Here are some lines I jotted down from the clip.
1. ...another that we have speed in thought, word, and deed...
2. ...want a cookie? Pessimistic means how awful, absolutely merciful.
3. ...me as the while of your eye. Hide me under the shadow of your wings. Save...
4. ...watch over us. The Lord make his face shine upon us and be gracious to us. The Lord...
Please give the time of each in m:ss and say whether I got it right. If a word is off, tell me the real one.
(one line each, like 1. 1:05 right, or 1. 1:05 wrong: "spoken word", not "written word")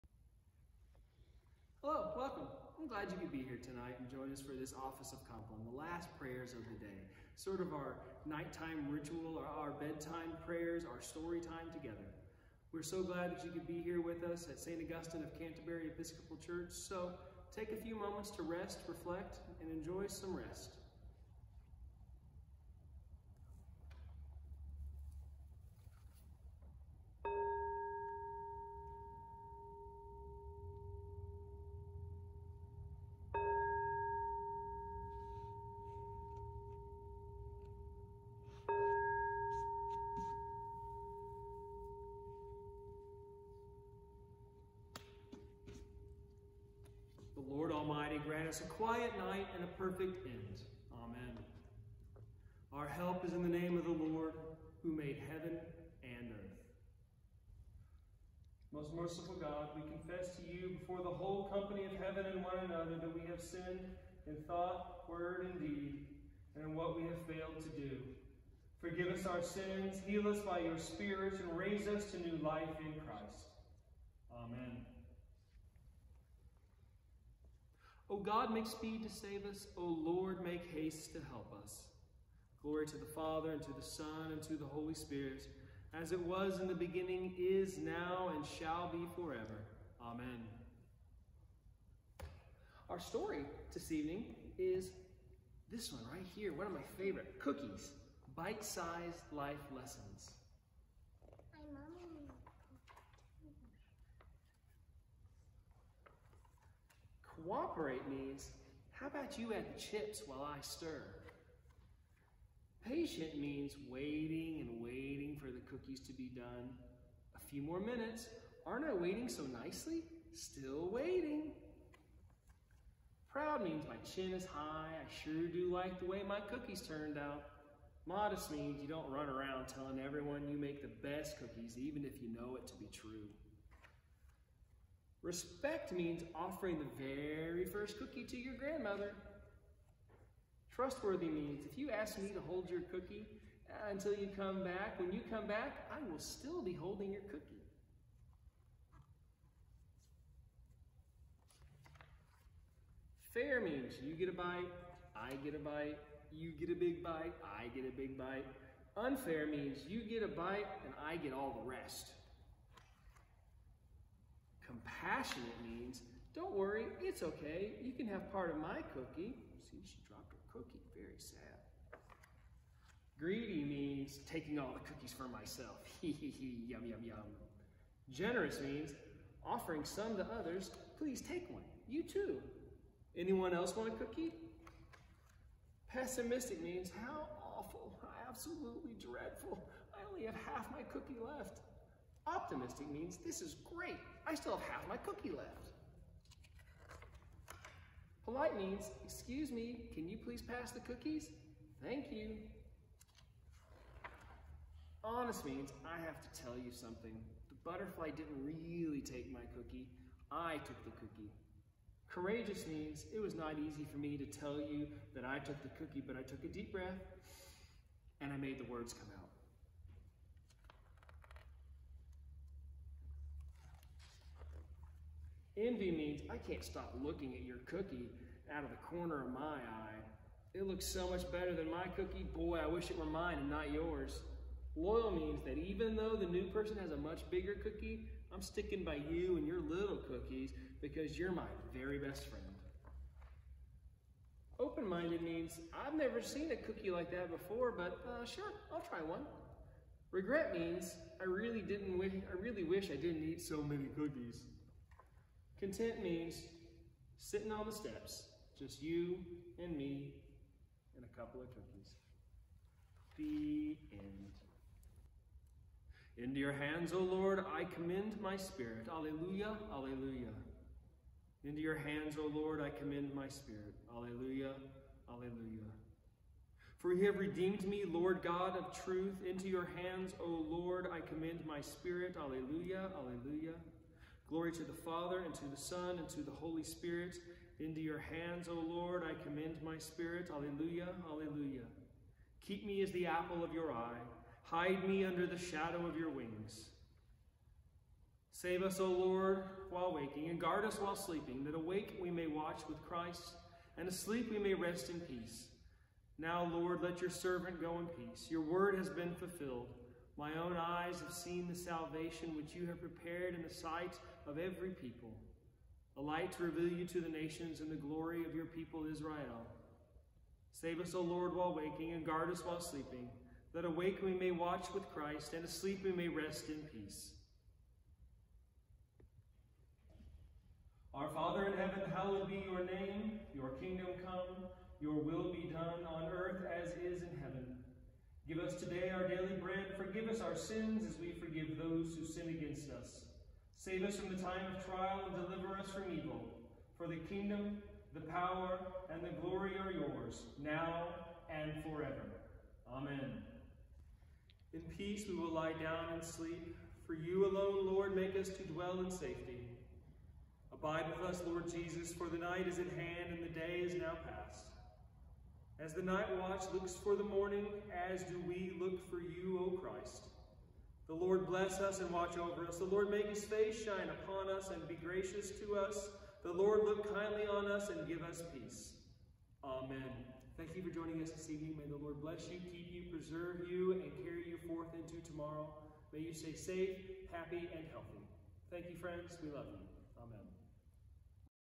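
1. 1:02 wrong: "sinned", not "speed"
2. 3:03 wrong: "dreadful", not "merciful"
3. 4:52 wrong: "apple", not "while"
4. 6:11 right.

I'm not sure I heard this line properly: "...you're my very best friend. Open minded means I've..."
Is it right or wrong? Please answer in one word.
right.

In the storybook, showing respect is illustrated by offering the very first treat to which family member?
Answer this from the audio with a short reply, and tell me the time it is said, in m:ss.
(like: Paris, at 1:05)
grandmother, at 2:18.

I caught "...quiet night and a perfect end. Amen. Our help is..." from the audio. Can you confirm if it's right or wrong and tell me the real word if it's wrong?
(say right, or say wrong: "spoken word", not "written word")
right.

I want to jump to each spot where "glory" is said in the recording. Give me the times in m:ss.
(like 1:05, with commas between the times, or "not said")
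1:22, 4:44, 5:17, 5:49.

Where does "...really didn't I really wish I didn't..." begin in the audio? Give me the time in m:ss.
4:11.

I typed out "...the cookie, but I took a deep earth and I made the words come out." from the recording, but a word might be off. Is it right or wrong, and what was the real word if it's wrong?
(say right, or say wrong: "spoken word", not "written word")
wrong: "breath", not "earth".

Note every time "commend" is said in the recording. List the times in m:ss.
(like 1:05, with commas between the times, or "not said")
4:27, 4:32, 4:41, 4:49.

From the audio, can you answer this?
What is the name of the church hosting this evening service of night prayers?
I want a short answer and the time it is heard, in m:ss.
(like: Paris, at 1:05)
St. Augustine of Canterbury Episcopal Church, at 0:14.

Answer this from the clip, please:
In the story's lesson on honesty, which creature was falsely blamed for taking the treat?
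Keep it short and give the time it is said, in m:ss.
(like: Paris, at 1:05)
The butterfly, at 3:27.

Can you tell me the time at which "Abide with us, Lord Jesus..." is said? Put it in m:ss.
6:00.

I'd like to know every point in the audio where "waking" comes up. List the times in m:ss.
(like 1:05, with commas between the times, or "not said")
4:59, 5:21.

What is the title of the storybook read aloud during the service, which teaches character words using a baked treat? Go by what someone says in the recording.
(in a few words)
Cookies, Bite-Sized Life Lessons.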